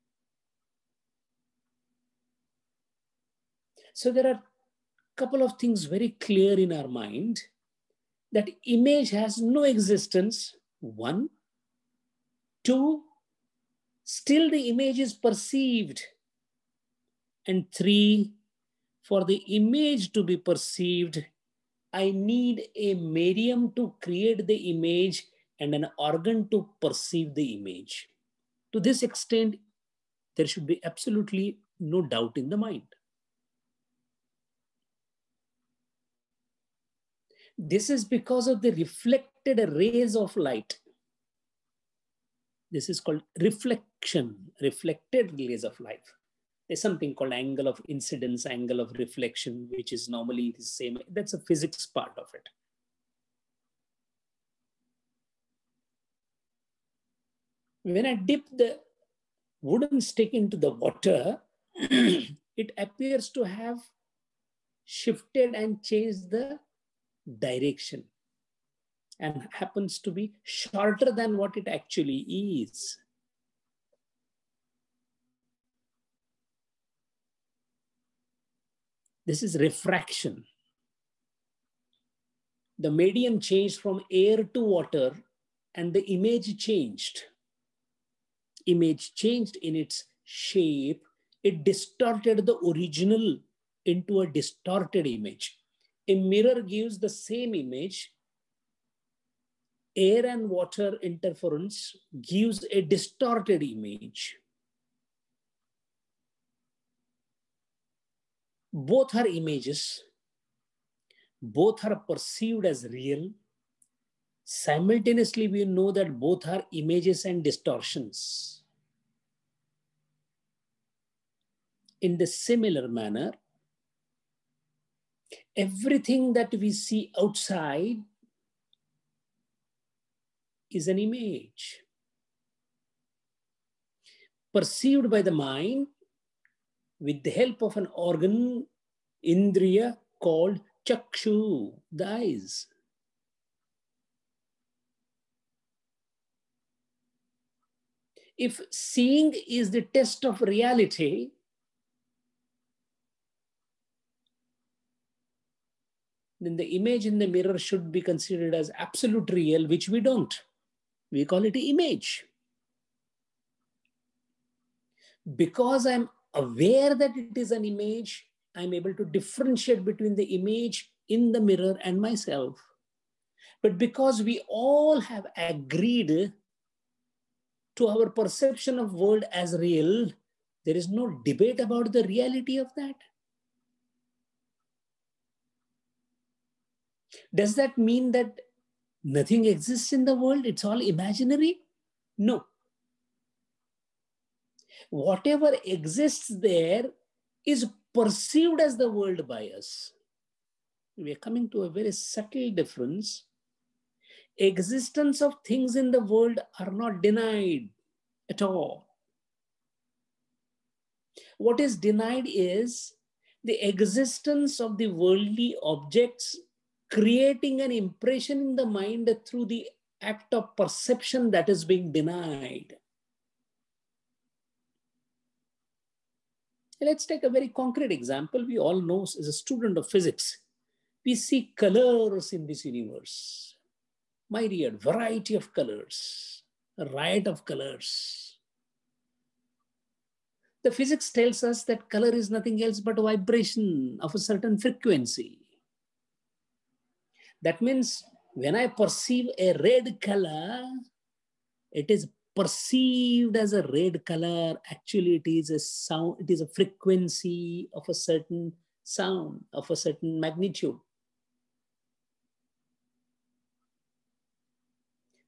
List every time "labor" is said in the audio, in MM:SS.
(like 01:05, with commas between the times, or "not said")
not said.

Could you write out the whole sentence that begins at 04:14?
Actually, it is a sound, it is a frequency of a certain sound, of a certain magnitude.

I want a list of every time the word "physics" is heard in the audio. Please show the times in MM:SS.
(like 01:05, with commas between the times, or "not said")
00:51, 03:49, 04:00.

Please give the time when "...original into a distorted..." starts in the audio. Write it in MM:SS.
01:32.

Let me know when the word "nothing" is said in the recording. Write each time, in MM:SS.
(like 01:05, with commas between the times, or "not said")
03:09, 04:02.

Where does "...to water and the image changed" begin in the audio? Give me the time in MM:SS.
01:24.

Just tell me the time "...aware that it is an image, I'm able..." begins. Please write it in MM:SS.
02:46.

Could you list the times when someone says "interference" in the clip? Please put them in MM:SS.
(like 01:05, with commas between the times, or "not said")
01:41.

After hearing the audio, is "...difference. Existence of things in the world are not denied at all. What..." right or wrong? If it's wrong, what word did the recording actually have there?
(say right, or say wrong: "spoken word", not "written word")
right.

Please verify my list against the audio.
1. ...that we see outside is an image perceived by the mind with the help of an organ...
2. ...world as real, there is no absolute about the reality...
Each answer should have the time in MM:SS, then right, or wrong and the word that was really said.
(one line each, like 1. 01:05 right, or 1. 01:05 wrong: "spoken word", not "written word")
1. 02:06 right
2. 02:58 wrong: "debate", not "absolute".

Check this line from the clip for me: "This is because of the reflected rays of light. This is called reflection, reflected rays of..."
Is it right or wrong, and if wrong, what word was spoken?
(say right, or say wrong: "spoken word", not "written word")
right.